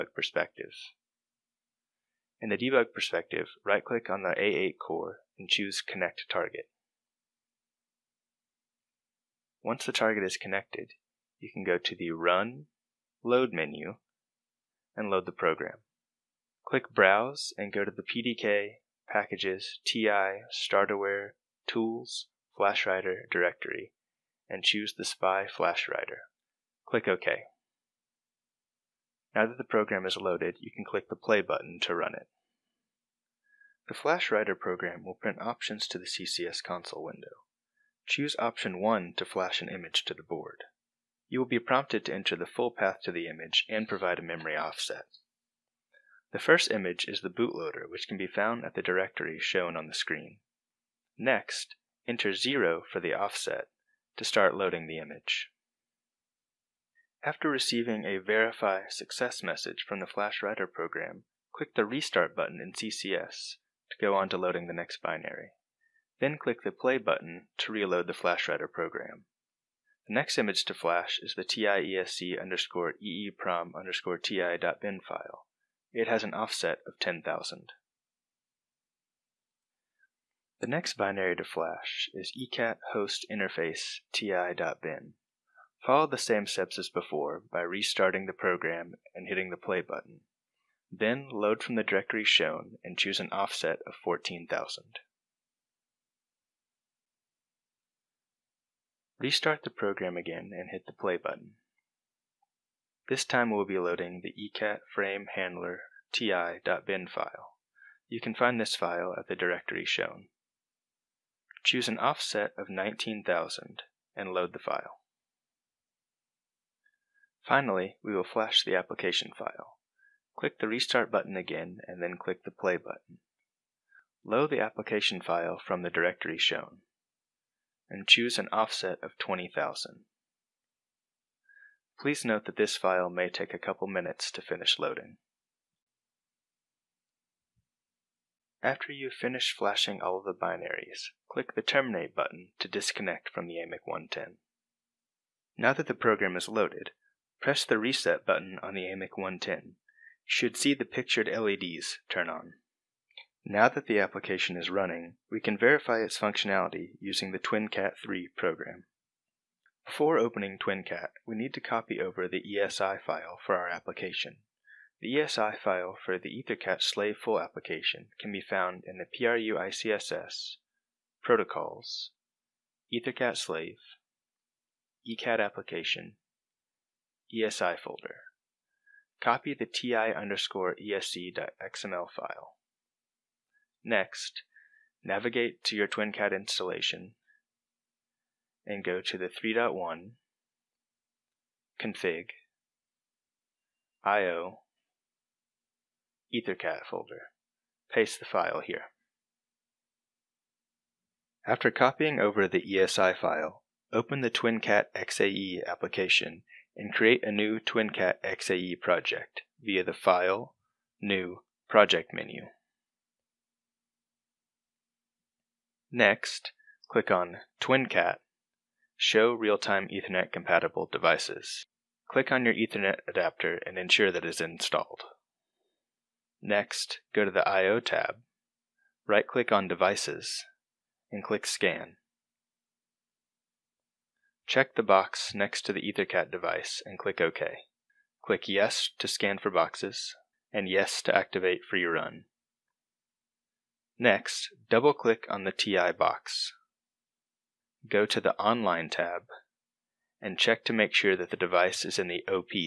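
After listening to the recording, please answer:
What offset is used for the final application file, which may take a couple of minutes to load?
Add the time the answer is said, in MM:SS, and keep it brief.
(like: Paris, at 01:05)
20,000, at 02:09.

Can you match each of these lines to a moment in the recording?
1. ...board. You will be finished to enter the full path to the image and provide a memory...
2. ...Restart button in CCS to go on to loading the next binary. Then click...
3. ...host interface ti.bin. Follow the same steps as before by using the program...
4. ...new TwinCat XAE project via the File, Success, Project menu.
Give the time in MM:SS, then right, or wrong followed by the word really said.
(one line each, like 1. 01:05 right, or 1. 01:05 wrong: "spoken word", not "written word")
1. 00:40 wrong: "prompted", not "finished"
2. 01:01 right
3. 01:22 wrong: "restarting", not "using"
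4. 03:27 wrong: "New", not "Success".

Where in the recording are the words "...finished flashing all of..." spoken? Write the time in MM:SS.
02:19.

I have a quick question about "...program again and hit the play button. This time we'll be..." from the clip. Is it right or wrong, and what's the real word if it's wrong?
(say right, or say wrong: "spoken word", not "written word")
right.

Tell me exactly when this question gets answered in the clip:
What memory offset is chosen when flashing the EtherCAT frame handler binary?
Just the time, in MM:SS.
01:52.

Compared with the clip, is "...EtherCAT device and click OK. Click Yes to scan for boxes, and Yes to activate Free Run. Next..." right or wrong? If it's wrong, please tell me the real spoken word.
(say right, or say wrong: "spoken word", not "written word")
right.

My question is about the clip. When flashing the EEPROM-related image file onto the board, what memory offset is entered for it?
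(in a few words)
10,000.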